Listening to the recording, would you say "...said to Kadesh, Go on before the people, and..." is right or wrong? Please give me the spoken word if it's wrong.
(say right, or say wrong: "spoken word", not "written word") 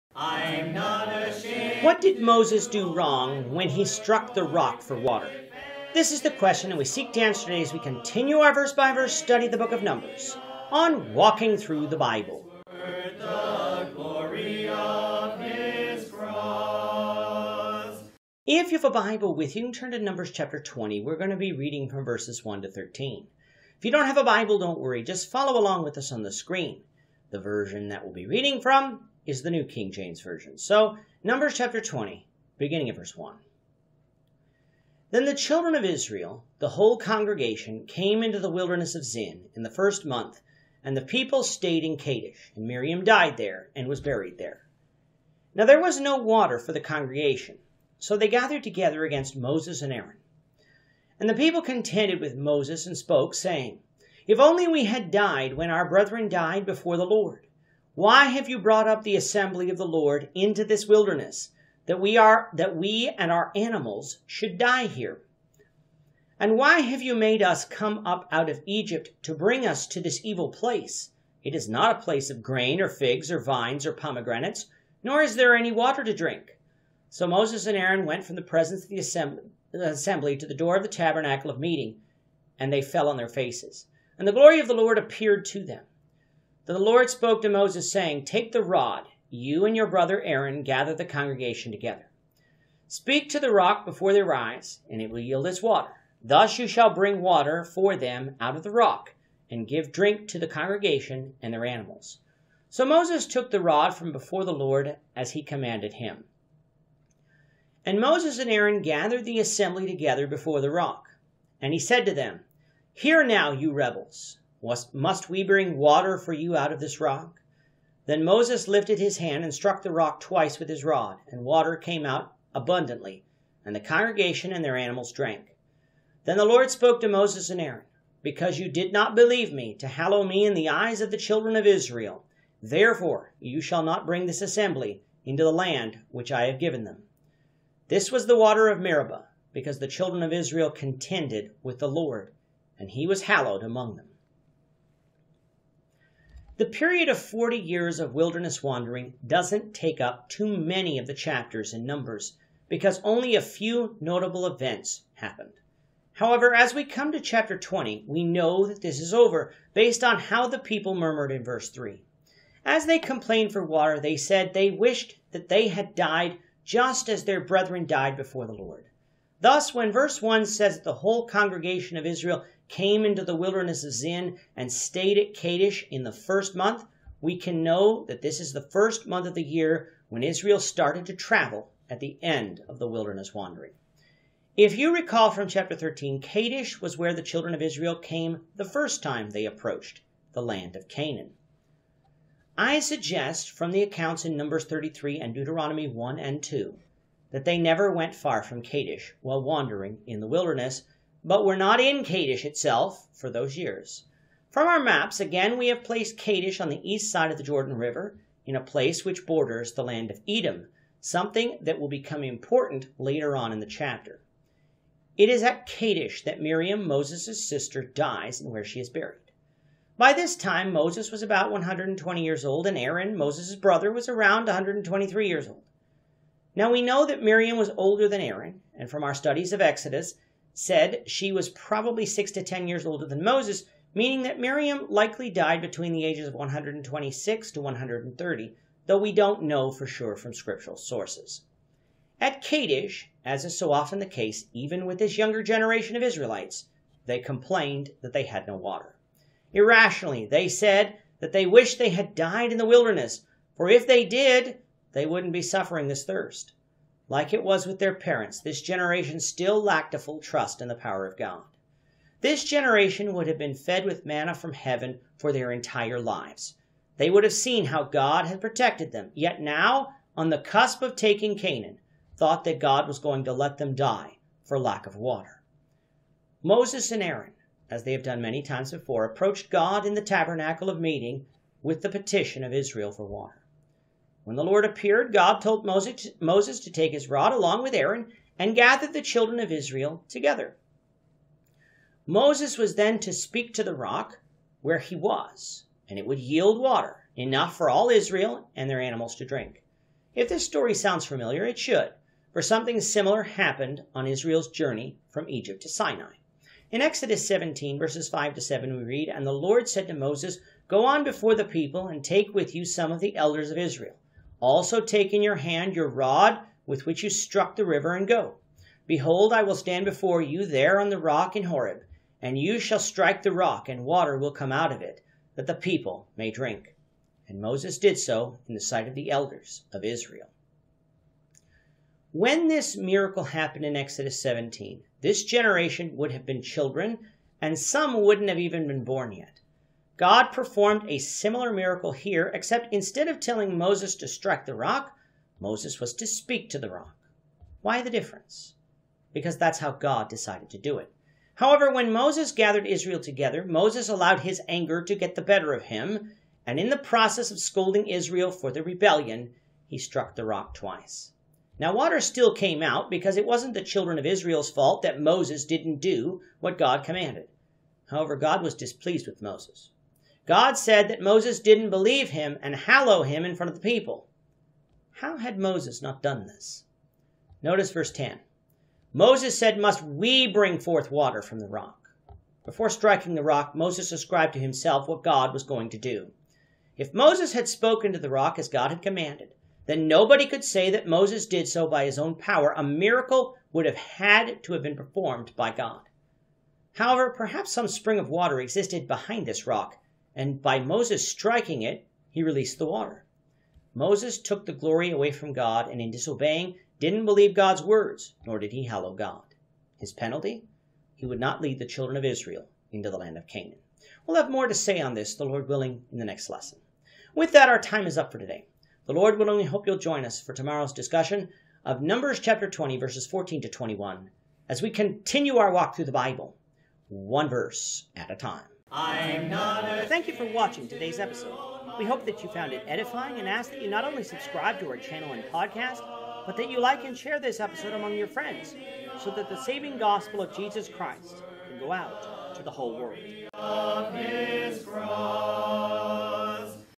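wrong: "Moses", not "Kadesh".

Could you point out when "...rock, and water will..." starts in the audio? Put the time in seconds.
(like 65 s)
323 s.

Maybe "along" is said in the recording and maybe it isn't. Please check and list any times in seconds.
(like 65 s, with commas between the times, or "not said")
25 s, 287 s.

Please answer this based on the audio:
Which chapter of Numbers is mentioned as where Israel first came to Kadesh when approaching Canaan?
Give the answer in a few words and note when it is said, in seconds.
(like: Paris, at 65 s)
Chapter 13, at 185 s.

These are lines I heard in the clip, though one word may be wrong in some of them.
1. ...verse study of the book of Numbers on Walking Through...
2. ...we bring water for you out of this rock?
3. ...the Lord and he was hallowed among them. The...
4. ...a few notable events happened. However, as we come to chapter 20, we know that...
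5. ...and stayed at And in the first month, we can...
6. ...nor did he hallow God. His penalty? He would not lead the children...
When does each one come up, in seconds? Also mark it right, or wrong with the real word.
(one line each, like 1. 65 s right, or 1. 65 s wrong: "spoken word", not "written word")
1. 8 s right
2. 115 s right
3. 141 s right
4. 153 s right
5. 174 s wrong: "Kadesh", not "And"
6. 408 s right.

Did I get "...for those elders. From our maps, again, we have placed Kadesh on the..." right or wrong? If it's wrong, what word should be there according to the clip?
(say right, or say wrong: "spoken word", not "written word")
wrong: "years", not "elders".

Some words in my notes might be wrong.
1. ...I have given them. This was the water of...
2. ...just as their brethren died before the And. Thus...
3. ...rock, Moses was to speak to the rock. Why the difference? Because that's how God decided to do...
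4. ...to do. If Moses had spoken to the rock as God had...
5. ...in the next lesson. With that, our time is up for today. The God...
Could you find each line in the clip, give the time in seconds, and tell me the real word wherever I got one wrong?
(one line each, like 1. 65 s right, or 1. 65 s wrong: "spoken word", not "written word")
1. 136 s right
2. 166 s wrong: "Lord", not "And"
3. 344 s right
4. 385 s right
5. 415 s wrong: "Lord", not "God".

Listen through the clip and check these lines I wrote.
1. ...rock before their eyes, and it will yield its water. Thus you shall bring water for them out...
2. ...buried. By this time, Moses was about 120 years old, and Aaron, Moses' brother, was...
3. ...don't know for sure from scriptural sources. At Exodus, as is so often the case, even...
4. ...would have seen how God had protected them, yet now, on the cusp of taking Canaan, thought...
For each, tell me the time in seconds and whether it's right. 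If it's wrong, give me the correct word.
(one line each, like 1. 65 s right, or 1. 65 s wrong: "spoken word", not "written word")
1. 93 s right
2. 218 s right
3. 239 s wrong: "Kadesh", not "Exodus"
4. 267 s right.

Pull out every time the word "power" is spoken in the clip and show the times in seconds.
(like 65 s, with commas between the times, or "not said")
260 s, 392 s.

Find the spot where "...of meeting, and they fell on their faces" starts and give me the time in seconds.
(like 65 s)
81 s.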